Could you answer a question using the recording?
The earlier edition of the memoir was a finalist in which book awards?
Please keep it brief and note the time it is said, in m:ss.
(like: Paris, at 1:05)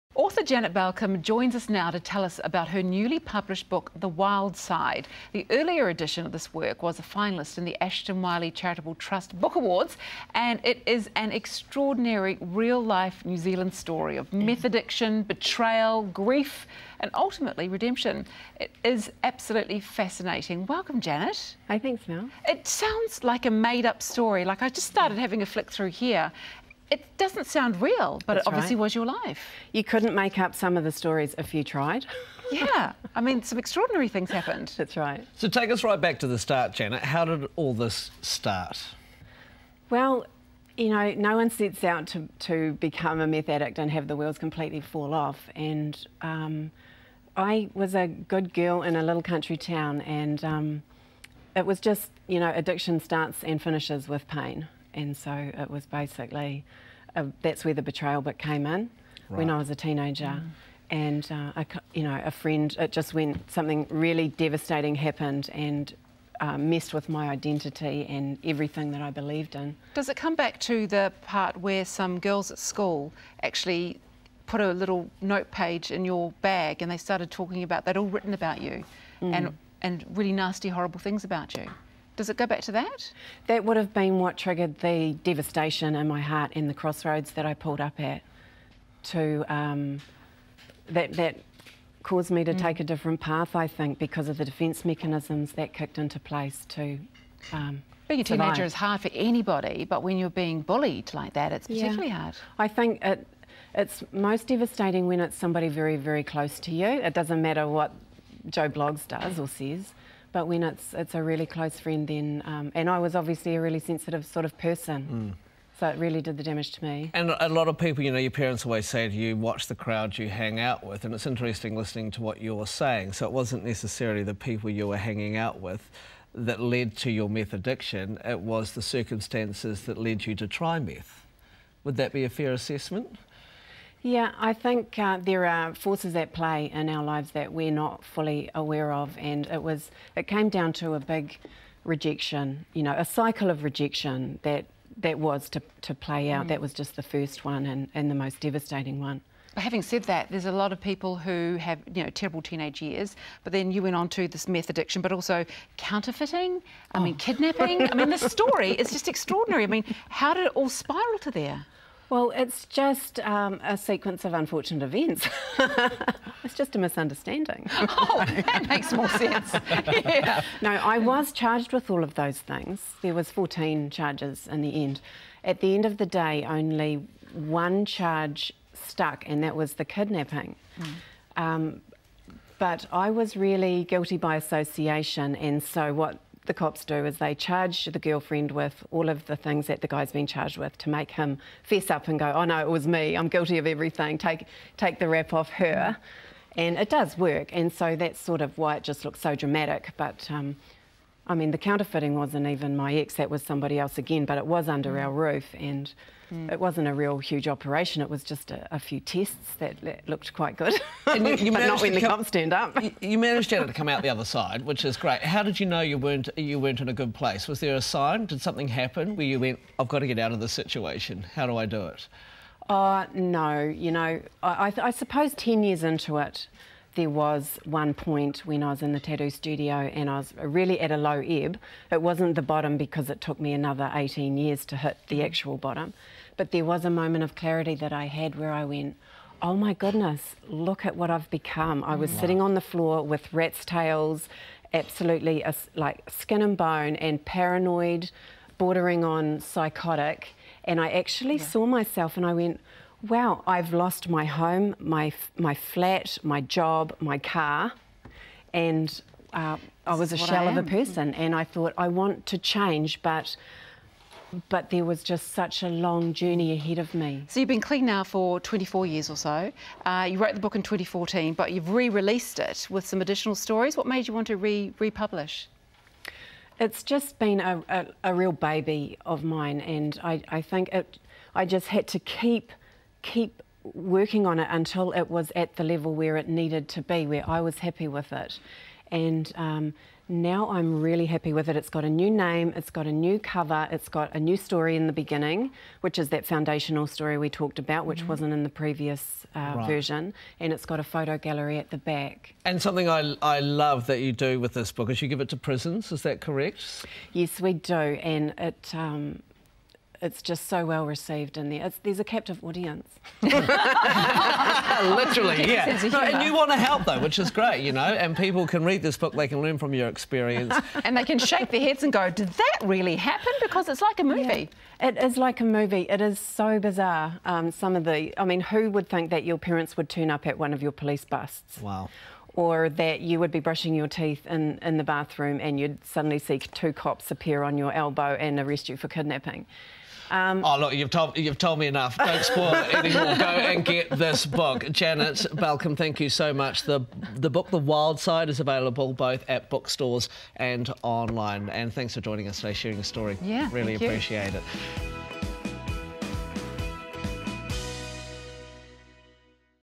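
Ashton Wylie Charitable Trust Book Awards, at 0:07.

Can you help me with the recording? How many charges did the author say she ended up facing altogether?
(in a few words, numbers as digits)
14.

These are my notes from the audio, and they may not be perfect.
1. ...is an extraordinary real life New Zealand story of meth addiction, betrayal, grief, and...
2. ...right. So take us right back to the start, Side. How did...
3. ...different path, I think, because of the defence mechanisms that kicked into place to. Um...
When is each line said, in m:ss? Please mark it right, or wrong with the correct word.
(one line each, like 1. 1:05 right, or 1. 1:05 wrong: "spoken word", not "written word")
1. 0:10 right
2. 0:34 wrong: "Janet", not "Side"
3. 1:32 right.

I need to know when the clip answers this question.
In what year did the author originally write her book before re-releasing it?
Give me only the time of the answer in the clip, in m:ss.
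4:30.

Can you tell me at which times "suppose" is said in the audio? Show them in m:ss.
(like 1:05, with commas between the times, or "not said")
3:44.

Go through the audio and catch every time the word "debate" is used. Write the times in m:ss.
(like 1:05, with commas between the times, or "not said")
not said.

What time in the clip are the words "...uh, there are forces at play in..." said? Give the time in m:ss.
2:14.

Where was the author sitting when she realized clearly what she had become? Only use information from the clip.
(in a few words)
The tattoo studio.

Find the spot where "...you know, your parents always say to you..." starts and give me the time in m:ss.
1:58.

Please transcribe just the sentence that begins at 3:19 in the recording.
But um, I mean, the counterfeiting wasn't even my ex, that was somebody else again, but it was under mm.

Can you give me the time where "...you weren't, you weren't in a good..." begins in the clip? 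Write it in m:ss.
3:35.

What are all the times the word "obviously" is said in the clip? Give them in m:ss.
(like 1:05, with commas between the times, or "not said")
0:28, 1:53.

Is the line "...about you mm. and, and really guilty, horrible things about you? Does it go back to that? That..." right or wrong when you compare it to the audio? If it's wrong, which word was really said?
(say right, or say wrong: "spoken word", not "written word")
wrong: "nasty", not "guilty".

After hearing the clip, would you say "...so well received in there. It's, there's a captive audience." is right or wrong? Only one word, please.
right.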